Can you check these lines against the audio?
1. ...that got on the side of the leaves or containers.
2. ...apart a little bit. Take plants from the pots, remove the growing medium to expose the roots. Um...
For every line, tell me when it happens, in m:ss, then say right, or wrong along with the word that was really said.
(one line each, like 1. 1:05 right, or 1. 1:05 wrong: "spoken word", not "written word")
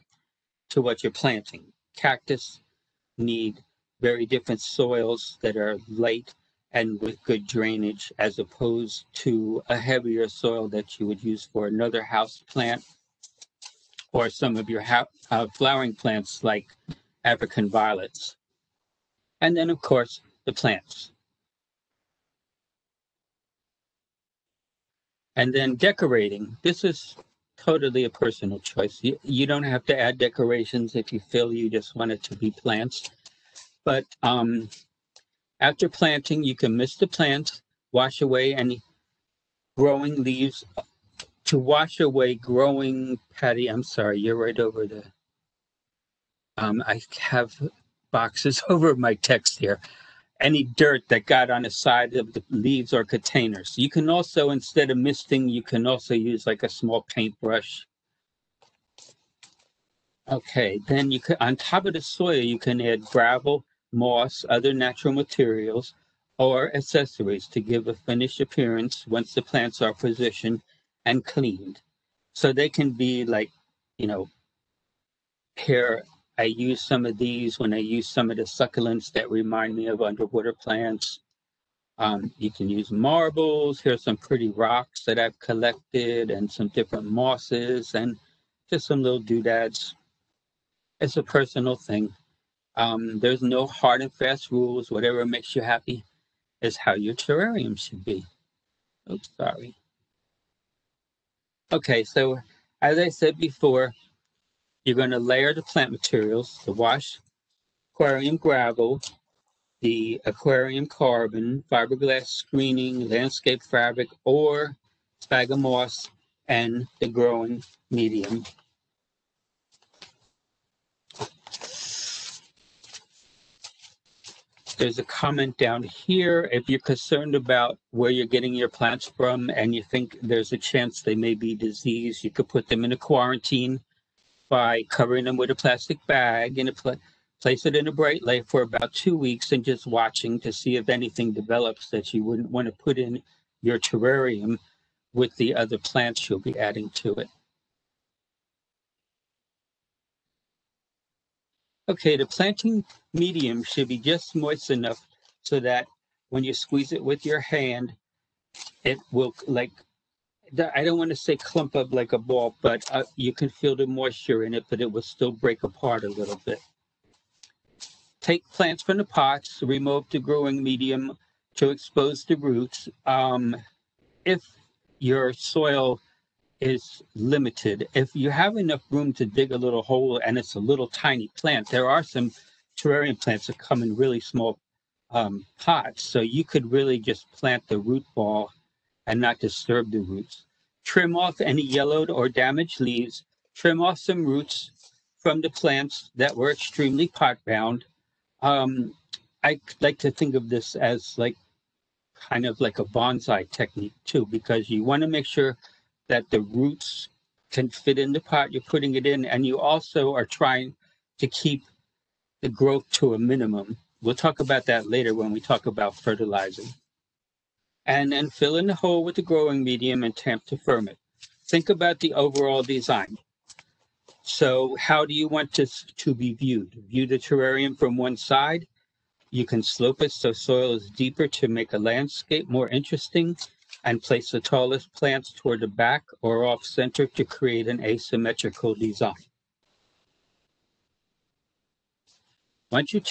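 1. 0:51 right
2. 2:45 right.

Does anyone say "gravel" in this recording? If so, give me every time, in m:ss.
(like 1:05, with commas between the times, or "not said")
1:03, 1:48.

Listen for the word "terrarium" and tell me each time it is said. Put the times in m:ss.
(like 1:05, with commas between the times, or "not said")
1:37, 2:23, 3:02, 3:47.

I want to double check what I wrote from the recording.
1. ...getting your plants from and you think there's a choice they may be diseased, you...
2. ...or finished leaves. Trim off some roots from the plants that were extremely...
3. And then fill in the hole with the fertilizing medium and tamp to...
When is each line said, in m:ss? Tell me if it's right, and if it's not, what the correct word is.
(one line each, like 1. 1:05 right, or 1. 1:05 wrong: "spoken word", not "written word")
1. 2:08 wrong: "chance", not "choice"
2. 3:12 wrong: "damaged", not "finished"
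3. 3:37 wrong: "growing", not "fertilizing".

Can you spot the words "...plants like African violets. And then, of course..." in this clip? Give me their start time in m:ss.
0:15.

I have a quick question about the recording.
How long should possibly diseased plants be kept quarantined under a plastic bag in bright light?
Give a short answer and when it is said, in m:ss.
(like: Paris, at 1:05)
2 weeks, at 2:18.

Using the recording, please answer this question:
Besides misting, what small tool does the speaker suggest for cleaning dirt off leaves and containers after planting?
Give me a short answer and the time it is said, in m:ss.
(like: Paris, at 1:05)
small paintbrush, at 0:56.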